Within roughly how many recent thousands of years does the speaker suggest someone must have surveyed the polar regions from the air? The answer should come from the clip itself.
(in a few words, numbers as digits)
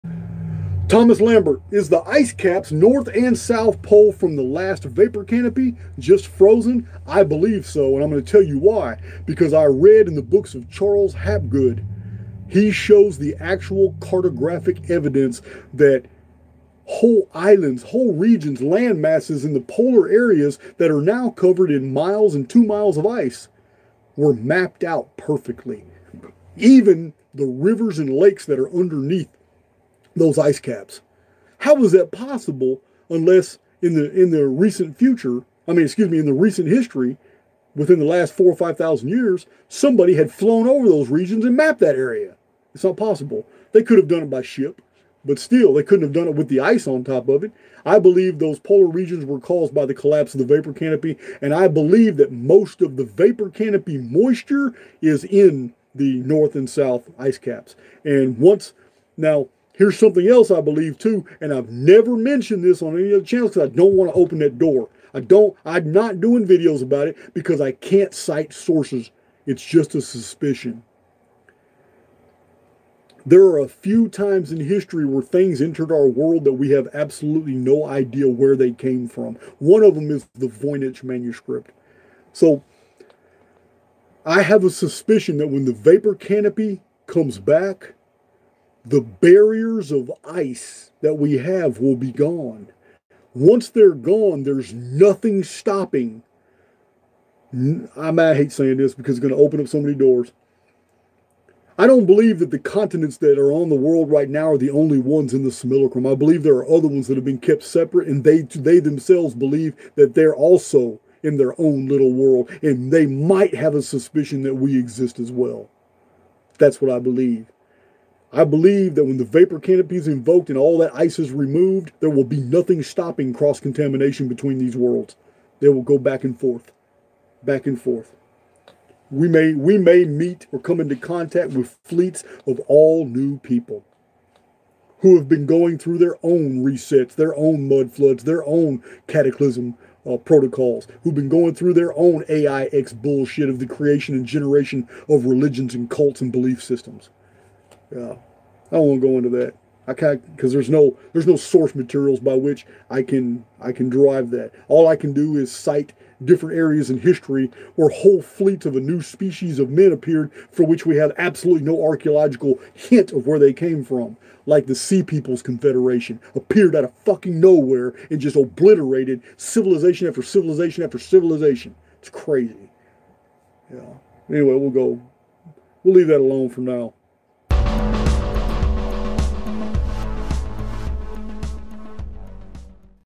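4 or 5 thousand years.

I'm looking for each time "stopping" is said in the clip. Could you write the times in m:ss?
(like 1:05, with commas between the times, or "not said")
1:35, 2:02.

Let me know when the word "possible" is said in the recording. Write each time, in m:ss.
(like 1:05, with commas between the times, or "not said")
0:32, 0:42.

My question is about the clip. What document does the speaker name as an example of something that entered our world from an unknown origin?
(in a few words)
Voynich manuscript.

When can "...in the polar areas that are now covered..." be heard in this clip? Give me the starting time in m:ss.
0:19.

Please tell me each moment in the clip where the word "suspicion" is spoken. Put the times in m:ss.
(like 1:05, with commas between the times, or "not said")
1:10, 1:24, 1:53.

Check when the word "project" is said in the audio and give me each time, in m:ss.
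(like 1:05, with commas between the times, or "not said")
not said.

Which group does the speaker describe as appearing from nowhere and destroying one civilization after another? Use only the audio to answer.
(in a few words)
Sea Peoples Confederation.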